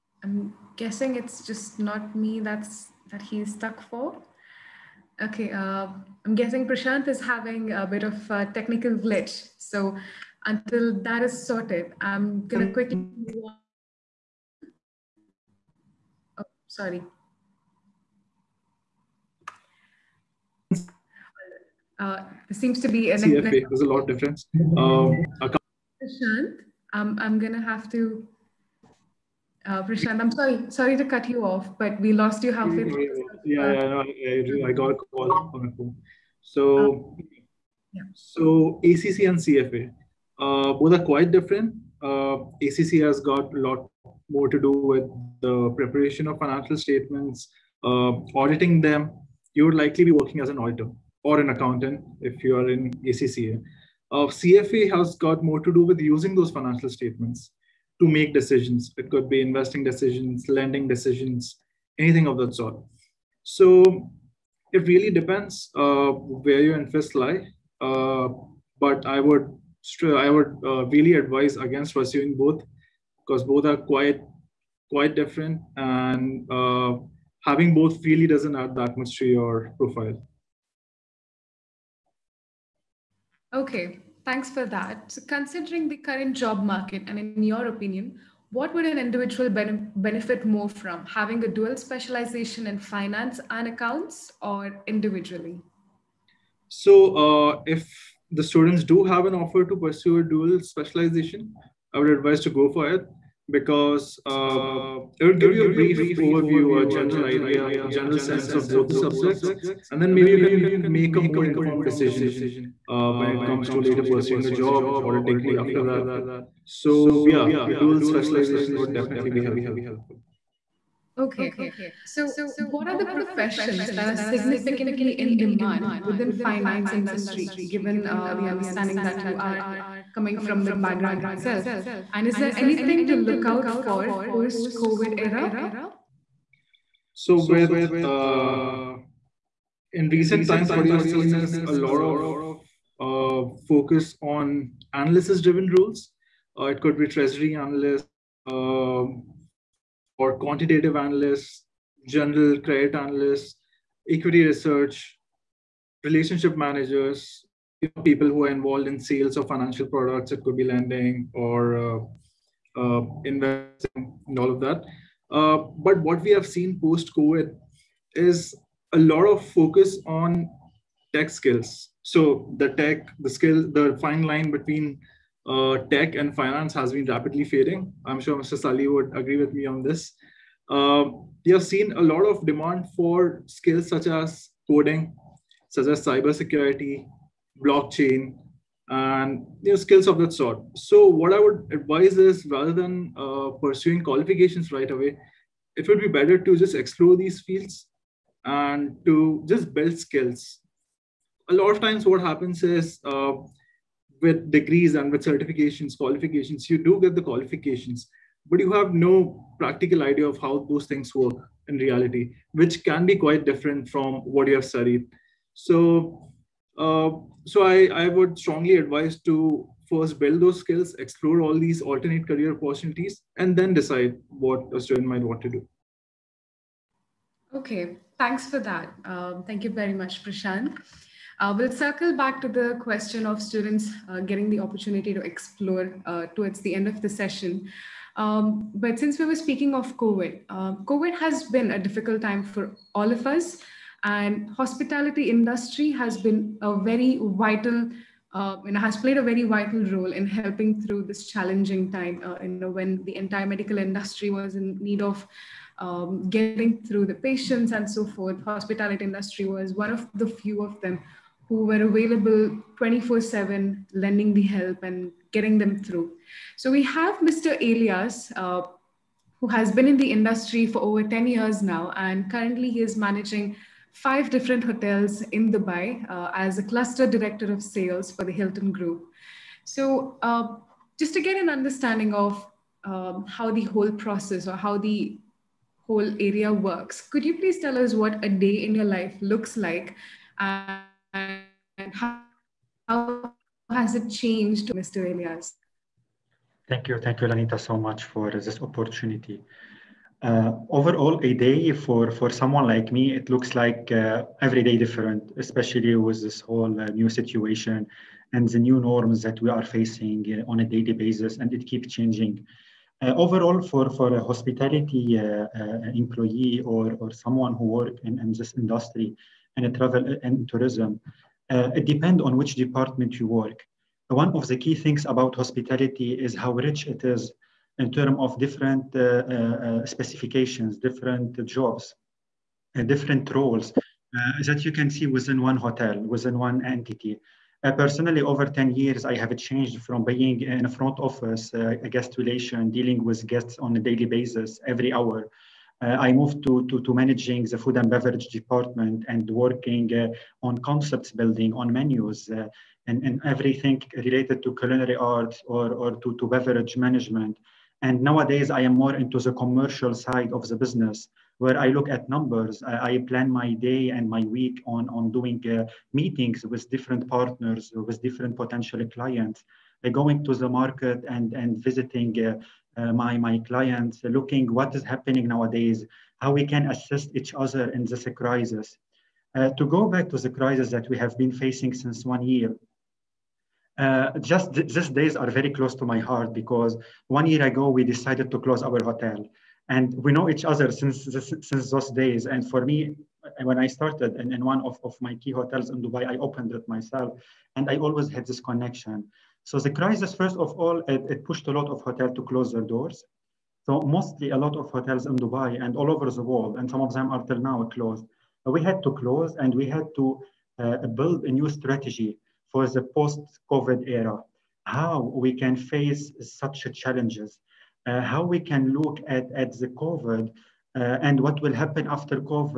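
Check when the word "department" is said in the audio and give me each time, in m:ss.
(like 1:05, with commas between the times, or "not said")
5:22, 5:48.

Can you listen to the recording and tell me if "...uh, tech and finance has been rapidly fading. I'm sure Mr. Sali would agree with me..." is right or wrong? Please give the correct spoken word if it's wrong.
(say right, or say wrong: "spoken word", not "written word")
right.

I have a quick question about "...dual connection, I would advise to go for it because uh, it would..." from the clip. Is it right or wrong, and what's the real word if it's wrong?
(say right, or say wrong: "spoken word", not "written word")
wrong: "specialization", not "connection".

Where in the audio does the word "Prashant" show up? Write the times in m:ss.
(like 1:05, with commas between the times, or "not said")
0:06, 0:25, 0:29, 3:50.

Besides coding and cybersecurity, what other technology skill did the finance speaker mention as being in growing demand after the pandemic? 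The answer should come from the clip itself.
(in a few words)
Blockchain.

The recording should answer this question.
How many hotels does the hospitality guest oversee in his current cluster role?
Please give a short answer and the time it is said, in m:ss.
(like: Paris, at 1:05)
5, at 4:33.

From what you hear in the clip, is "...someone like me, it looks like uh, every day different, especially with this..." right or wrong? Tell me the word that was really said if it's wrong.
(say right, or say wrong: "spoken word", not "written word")
right.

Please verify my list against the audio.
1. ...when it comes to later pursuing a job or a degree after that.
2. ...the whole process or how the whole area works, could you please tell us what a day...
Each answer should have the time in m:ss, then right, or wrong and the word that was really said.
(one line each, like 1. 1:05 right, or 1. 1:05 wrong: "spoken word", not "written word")
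1. 1:53 right
2. 4:43 right.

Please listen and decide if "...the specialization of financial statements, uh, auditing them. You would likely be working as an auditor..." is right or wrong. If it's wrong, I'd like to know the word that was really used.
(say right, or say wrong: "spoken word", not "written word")
wrong: "preparation", not "specialization".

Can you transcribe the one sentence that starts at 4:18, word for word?
Hospitality industry was one of the few of them who were available 24 7, lending the help and getting them through.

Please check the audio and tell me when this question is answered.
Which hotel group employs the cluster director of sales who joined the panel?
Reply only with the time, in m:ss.
4:38.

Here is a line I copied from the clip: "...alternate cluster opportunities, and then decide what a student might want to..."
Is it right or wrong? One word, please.
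wrong.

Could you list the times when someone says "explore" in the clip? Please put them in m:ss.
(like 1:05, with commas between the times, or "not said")
3:16, 3:40, 3:55.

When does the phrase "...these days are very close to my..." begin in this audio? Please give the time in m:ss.
6:24.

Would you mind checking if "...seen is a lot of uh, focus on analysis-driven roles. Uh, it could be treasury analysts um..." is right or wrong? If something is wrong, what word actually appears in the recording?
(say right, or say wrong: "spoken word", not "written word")
right.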